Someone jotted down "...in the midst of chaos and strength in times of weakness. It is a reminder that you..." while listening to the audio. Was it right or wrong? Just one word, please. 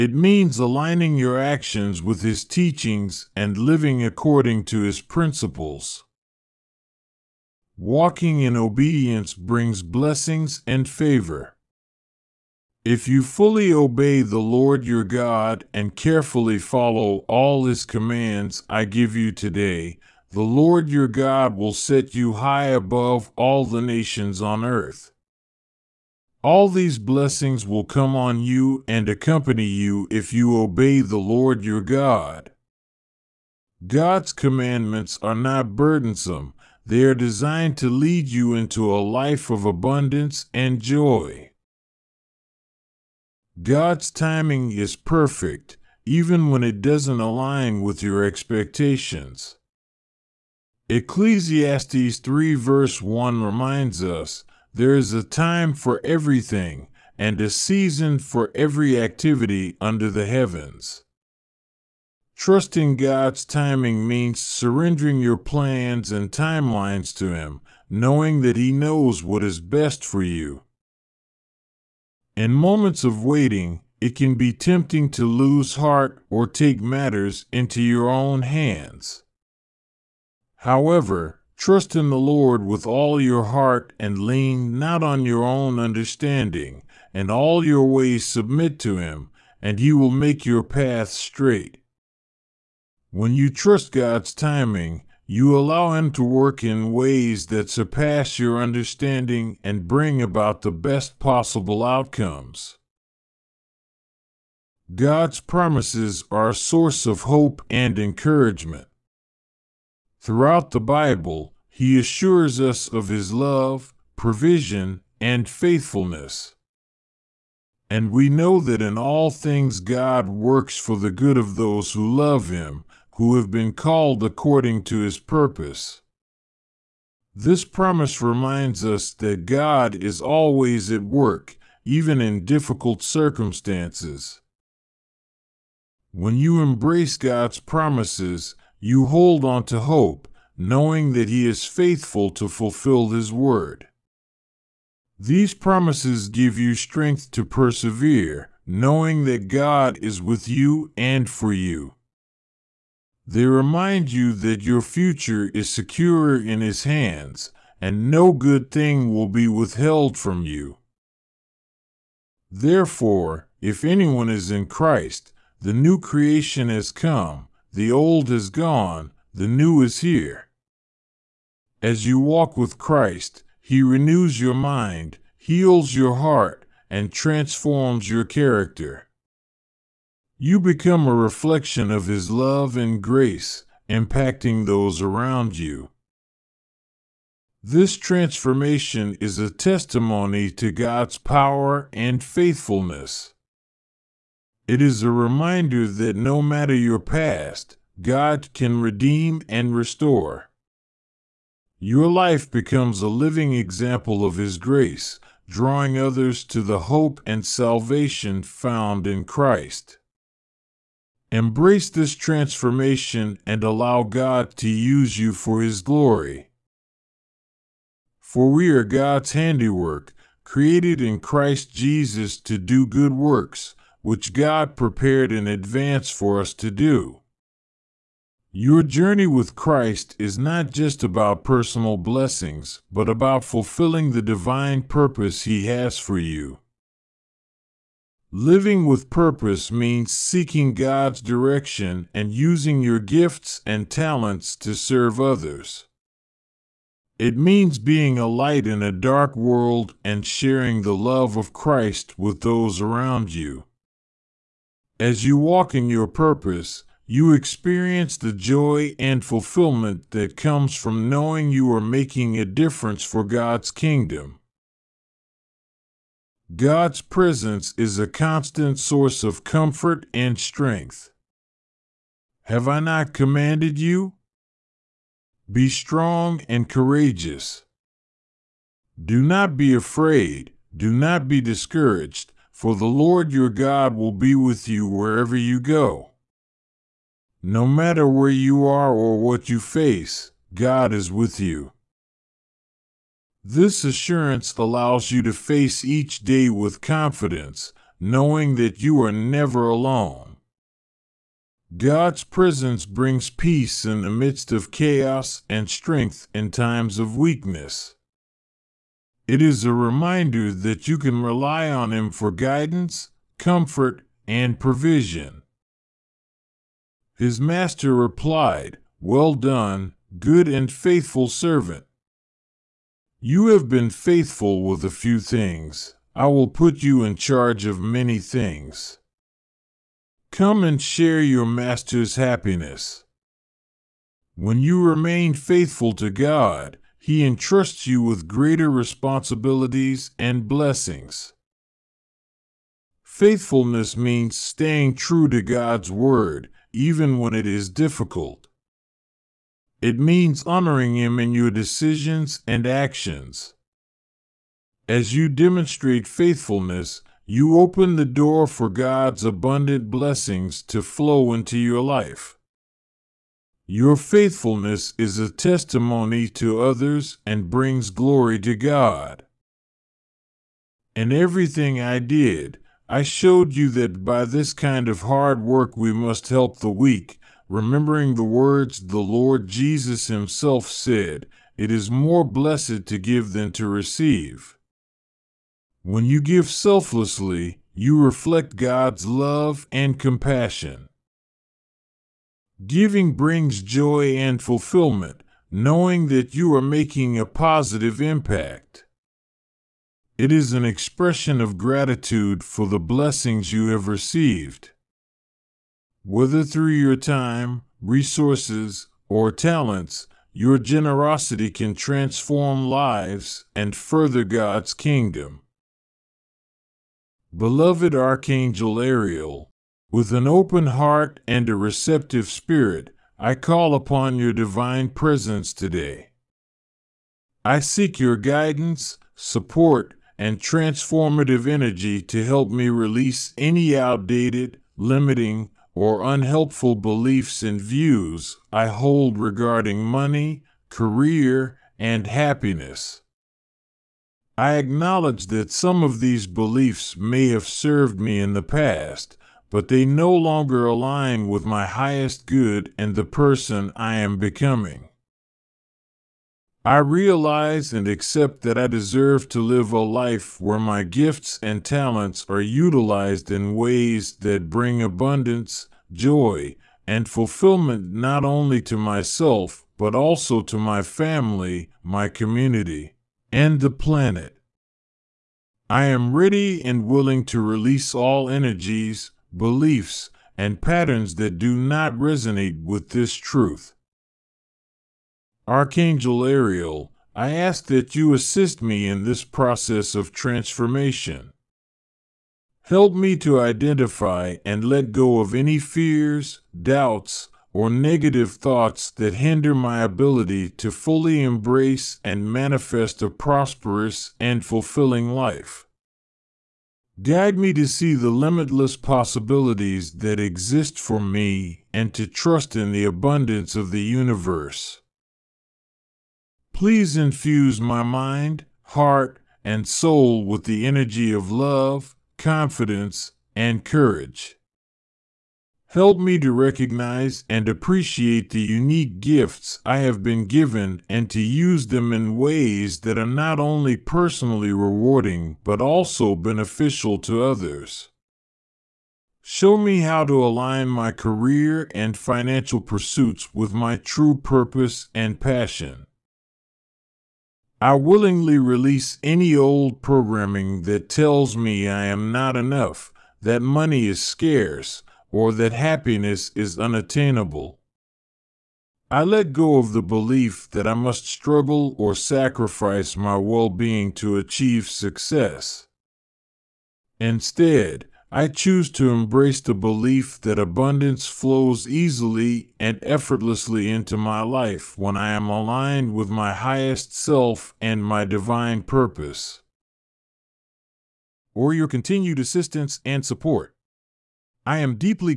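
right.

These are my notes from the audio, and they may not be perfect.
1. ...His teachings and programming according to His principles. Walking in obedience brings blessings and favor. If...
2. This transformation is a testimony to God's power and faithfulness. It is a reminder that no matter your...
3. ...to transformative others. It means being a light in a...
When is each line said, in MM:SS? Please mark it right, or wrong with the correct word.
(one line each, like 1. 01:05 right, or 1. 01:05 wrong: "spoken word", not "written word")
1. 00:02 wrong: "living", not "programming"
2. 03:07 right
3. 04:04 wrong: "serve", not "transformative".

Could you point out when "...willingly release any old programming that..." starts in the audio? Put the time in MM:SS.
09:07.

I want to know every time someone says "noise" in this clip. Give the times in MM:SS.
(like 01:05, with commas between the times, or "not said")
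not said.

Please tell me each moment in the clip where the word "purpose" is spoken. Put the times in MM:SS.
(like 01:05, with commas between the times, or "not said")
02:05, 03:54, 03:59, 04:16, 09:04, 09:38.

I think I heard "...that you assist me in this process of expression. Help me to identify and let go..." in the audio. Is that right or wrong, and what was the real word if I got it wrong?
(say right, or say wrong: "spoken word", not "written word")
wrong: "transformation", not "expression".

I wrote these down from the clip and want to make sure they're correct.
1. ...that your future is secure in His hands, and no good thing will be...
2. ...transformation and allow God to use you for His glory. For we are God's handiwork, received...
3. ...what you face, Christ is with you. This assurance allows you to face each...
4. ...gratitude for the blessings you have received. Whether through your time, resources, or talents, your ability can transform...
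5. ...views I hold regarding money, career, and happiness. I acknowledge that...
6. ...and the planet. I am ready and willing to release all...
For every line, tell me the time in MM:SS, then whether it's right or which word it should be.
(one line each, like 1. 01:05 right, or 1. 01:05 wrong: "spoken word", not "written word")
1. 02:34 right
2. 03:32 wrong: "created", not "received"
3. 04:49 wrong: "God", not "Christ"
4. 06:41 wrong: "generosity", not "ability"
5. 07:17 right
6. 07:53 right.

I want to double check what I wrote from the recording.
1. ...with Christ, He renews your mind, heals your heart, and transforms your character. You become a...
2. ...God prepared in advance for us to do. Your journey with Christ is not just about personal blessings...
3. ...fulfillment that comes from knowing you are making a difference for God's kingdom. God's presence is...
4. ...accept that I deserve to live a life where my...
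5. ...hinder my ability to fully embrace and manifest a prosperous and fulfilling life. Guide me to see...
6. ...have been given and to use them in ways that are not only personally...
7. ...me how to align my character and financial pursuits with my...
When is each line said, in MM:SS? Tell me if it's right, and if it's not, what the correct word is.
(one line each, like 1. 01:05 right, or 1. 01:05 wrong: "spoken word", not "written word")
1. 02:52 right
2. 03:44 right
3. 04:19 right
4. 07:37 right
5. 08:19 right
6. 08:49 right
7. 08:59 wrong: "career", not "character".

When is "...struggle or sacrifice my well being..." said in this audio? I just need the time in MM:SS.
09:21.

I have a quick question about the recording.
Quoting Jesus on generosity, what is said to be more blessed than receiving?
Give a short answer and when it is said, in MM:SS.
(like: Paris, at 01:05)
To give, at 06:22.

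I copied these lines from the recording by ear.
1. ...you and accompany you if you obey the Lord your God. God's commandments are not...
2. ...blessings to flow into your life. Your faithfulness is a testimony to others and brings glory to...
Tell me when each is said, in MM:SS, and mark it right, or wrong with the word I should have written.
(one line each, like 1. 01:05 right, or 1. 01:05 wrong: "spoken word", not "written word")
1. 00:28 right
2. 05:59 right.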